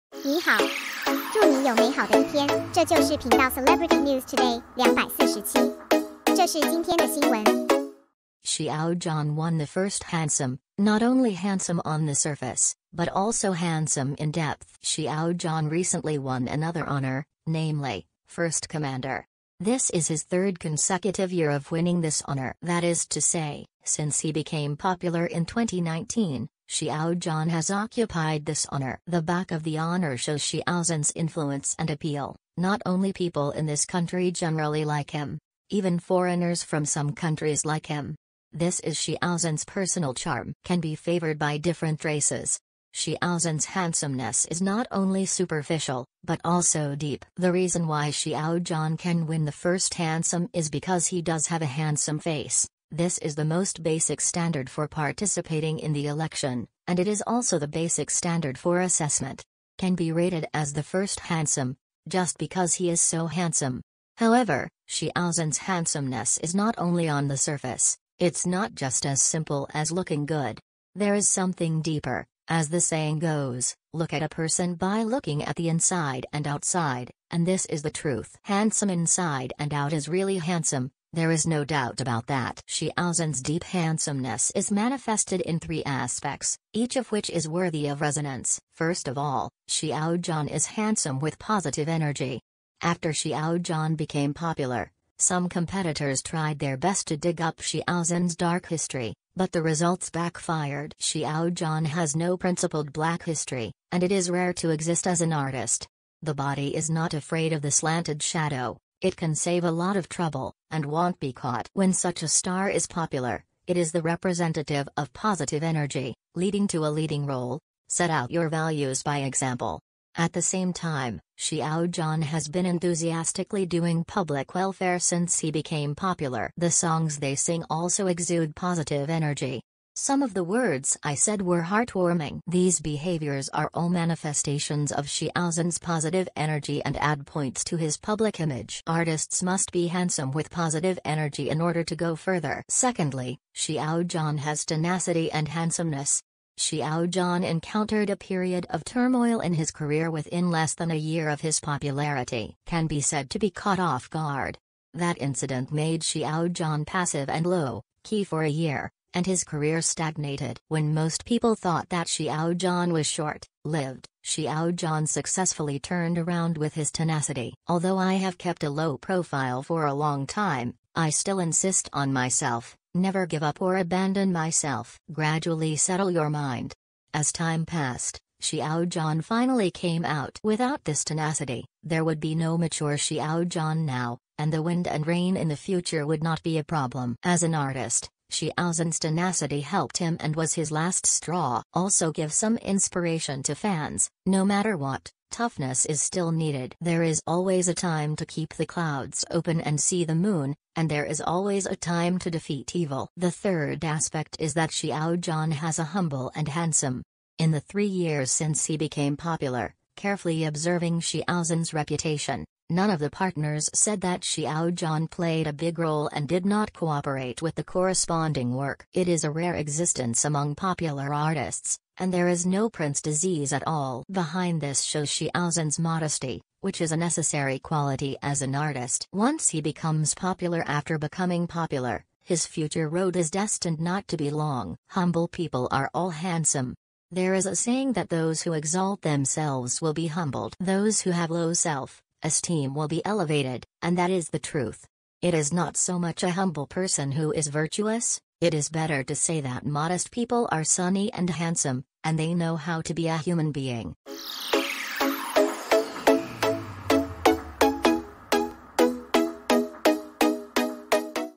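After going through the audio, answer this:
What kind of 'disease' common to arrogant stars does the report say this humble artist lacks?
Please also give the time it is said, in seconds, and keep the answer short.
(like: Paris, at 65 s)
Prince disease, at 222 s.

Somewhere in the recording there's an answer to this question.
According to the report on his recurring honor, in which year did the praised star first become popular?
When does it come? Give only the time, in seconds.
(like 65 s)
25 s.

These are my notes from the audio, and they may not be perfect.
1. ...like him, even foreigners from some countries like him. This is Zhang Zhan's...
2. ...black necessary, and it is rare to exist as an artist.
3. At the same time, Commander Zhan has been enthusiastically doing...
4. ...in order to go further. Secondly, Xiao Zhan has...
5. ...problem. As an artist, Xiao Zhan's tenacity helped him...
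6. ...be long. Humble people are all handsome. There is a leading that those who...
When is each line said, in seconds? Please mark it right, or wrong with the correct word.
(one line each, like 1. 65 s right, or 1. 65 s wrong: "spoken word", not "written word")
1. 34 s wrong: "Xiao", not "Zhang"
2. 102 s wrong: "history", not "necessary"
3. 120 s wrong: "Xiao", not "Commander"
4. 141 s right
5. 186 s right
6. 234 s wrong: "saying", not "leading".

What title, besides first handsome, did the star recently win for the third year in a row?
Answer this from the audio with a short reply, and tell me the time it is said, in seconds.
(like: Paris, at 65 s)
First Commander, at 18 s.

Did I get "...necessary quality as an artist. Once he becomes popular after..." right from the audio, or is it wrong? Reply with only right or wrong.
right.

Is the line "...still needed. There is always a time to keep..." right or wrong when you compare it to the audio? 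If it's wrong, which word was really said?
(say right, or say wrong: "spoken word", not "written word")
right.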